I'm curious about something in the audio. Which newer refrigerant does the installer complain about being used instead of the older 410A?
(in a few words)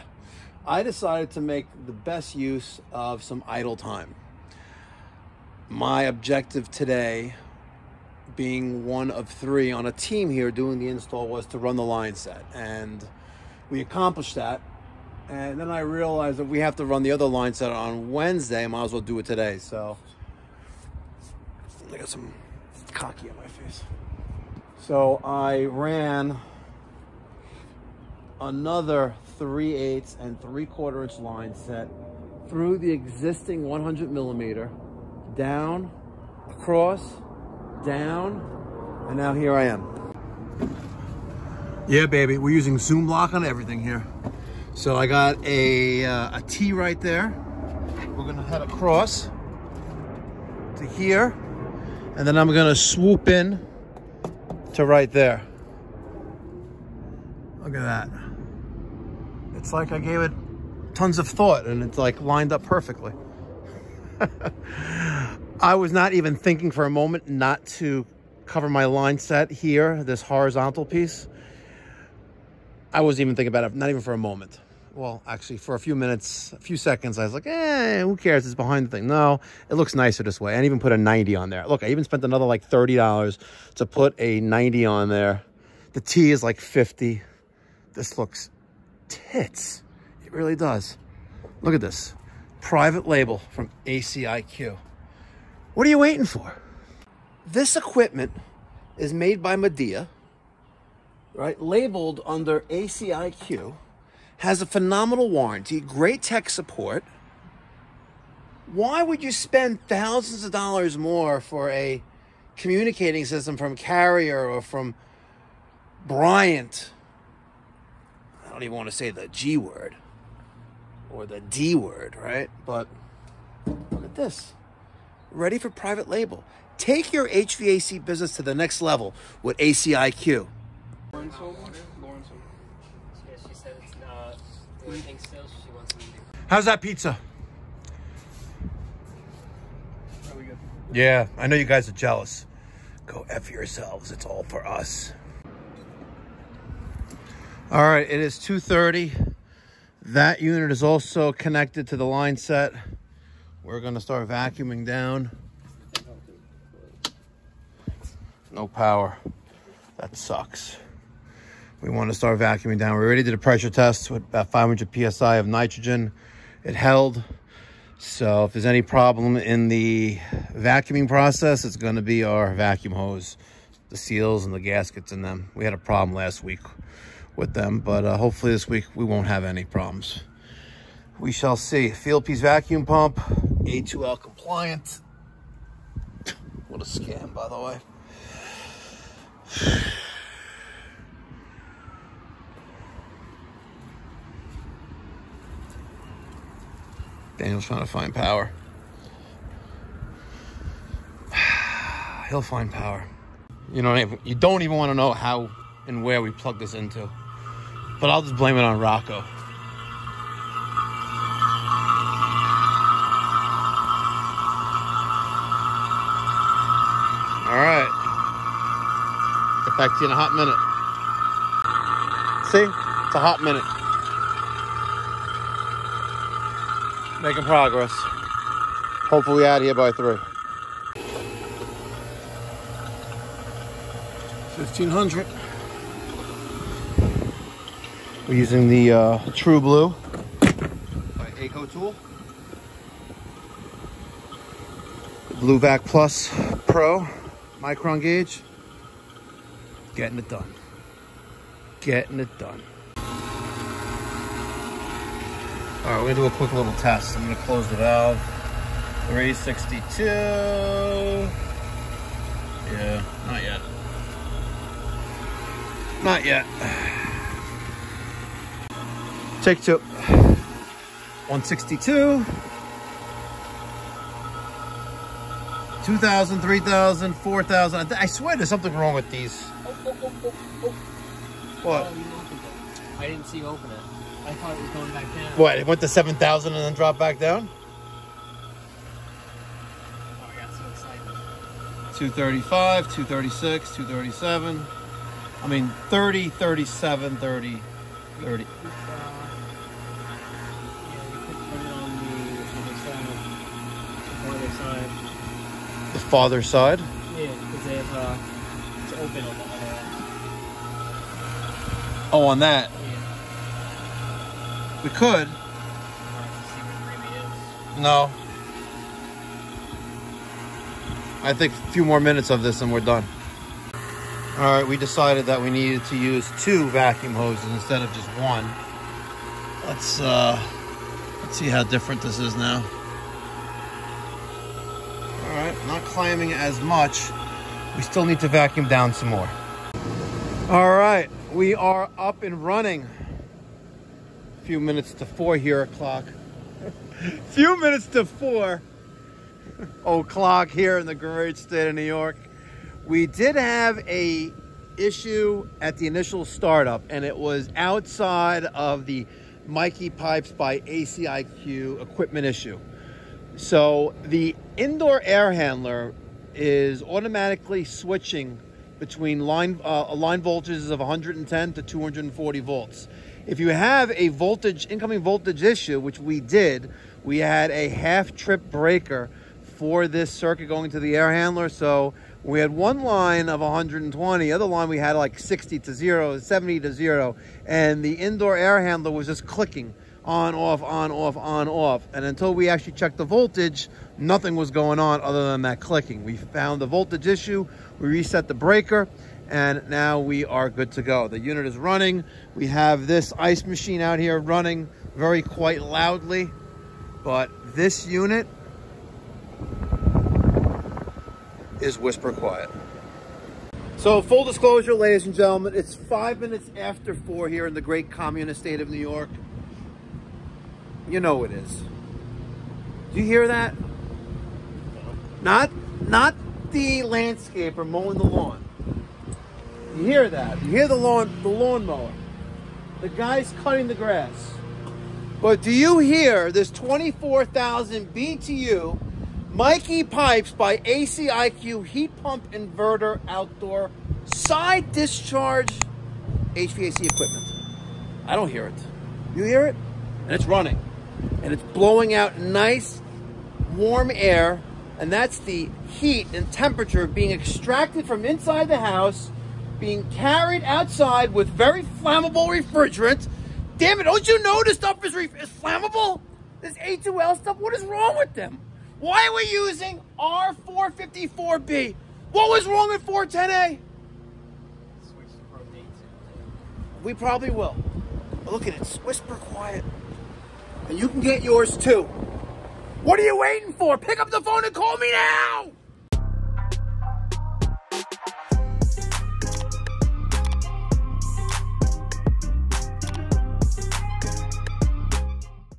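R454B.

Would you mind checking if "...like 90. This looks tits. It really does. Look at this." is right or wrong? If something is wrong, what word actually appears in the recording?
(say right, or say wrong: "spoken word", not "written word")
wrong: "50", not "90".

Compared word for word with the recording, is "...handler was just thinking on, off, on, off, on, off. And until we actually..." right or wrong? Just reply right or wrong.
wrong.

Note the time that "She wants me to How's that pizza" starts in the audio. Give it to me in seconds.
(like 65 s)
135 s.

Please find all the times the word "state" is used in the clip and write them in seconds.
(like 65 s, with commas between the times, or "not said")
351 s, 418 s.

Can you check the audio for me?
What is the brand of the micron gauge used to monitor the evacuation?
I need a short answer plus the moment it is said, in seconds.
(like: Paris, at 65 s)
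AccuTool, at 241 s.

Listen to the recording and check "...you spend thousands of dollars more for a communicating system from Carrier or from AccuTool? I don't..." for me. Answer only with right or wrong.
wrong.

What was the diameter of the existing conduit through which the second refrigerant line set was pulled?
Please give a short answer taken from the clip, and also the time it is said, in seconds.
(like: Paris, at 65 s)
100 millimeter, at 33 s.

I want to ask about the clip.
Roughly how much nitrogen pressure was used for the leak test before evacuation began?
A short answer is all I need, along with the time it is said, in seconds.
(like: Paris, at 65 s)
500 psi, at 164 s.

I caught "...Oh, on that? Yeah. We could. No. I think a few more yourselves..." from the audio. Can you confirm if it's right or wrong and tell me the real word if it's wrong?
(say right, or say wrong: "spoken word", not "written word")
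wrong: "minutes", not "yourselves".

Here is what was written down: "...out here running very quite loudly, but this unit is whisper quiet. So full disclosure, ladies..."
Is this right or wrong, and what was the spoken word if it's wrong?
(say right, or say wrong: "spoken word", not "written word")
right.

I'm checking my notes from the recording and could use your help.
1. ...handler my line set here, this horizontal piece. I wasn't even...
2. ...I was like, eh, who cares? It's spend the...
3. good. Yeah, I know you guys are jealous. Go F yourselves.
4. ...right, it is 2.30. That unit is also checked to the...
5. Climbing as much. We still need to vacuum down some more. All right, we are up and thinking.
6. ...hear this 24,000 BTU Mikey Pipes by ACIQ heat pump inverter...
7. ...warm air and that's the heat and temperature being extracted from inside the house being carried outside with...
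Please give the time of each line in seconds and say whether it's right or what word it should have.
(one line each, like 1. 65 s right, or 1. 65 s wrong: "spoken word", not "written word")
1. 68 s wrong: "cover", not "handler"
2. 77 s wrong: "behind", not "spend"
3. 140 s right
4. 147 s wrong: "connected", not "checked"
5. 335 s wrong: "running", not "thinking"
6. 435 s right
7. 453 s right.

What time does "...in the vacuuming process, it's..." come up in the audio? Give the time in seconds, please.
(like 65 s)
169 s.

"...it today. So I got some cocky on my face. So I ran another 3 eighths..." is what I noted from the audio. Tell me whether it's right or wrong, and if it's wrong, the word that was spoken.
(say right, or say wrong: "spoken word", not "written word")
right.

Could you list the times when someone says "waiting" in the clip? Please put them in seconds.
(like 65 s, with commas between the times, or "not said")
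95 s, 483 s.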